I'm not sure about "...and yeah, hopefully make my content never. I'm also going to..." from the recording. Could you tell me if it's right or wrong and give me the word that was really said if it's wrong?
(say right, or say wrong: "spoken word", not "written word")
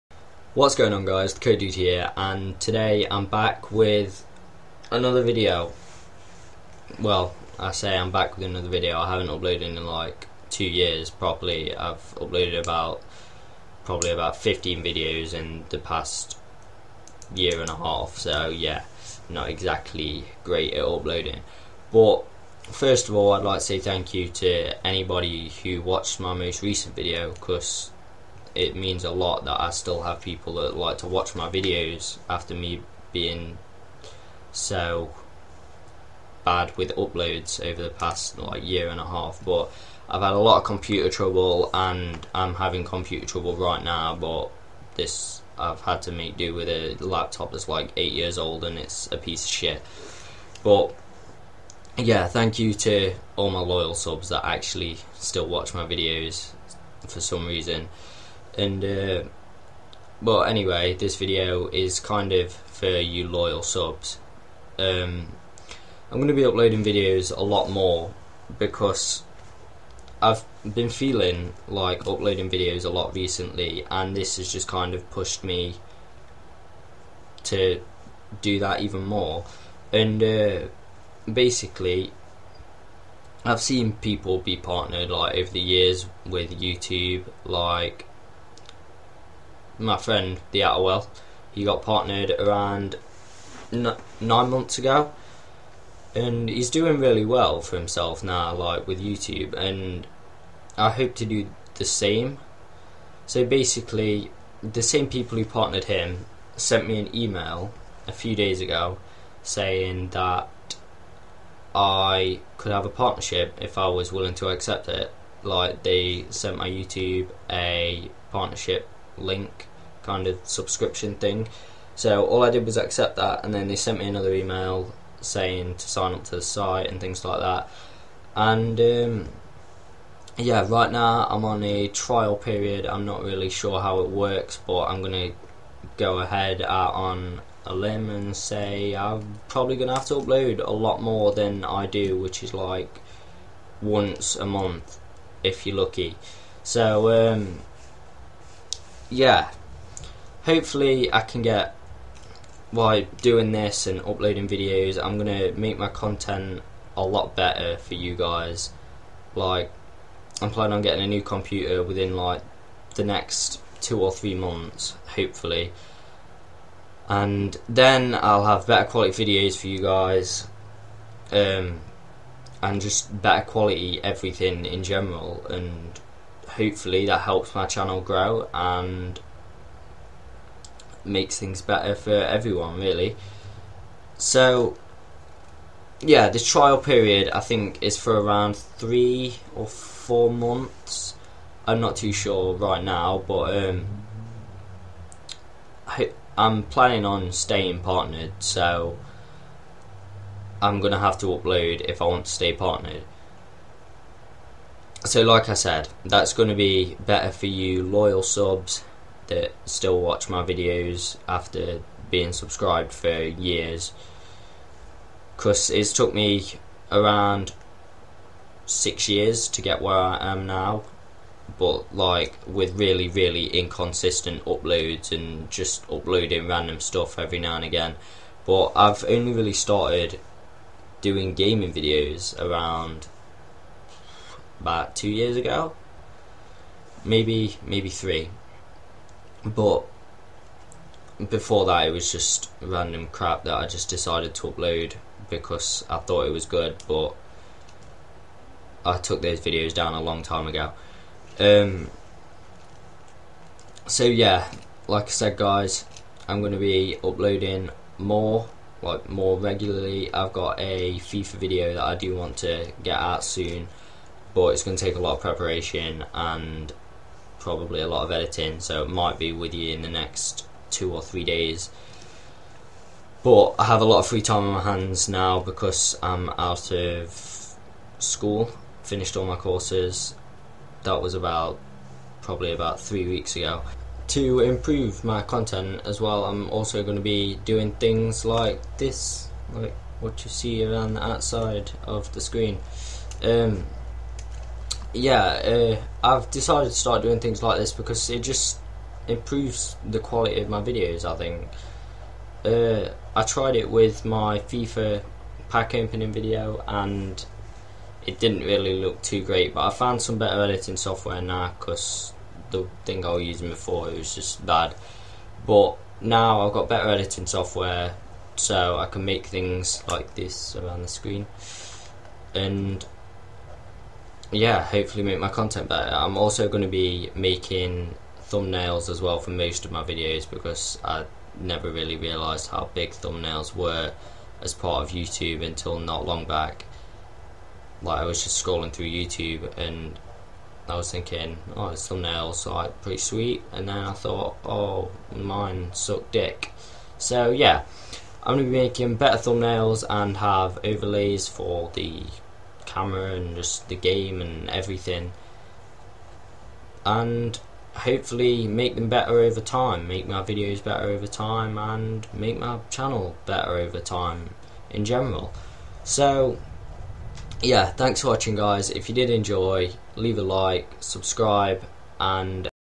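wrong: "better", not "never".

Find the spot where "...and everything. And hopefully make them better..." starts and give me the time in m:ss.
5:54.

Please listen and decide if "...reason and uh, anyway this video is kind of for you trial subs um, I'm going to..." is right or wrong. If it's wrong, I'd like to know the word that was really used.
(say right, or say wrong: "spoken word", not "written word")
wrong: "loyal", not "trial".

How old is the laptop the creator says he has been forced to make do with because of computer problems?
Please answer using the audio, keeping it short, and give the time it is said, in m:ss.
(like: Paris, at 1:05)
8 years old, at 0:47.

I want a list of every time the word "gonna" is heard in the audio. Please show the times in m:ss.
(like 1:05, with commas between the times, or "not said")
2:15, 2:19, 2:35, 3:20, 3:26, 5:48.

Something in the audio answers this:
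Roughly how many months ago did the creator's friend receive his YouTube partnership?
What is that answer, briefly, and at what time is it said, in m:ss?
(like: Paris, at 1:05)
9 months, at 1:33.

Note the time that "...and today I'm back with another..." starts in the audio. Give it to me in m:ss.
0:02.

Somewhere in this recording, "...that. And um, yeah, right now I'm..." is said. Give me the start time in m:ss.
2:07.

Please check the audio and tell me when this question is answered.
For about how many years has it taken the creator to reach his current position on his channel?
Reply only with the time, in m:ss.
3:38.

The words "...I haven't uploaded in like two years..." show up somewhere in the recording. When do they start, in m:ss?
0:08.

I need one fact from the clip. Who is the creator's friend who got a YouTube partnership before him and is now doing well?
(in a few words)
the Atterwell.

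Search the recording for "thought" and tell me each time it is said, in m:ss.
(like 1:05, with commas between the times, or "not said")
4:05, 5:43.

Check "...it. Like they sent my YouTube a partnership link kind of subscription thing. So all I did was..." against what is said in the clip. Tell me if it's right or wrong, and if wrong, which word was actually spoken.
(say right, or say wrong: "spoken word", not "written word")
right.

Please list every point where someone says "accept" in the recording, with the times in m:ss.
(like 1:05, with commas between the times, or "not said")
1:54, 2:02.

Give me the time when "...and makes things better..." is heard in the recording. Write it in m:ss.
2:58.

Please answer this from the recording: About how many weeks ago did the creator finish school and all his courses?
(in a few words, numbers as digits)
3 weeks.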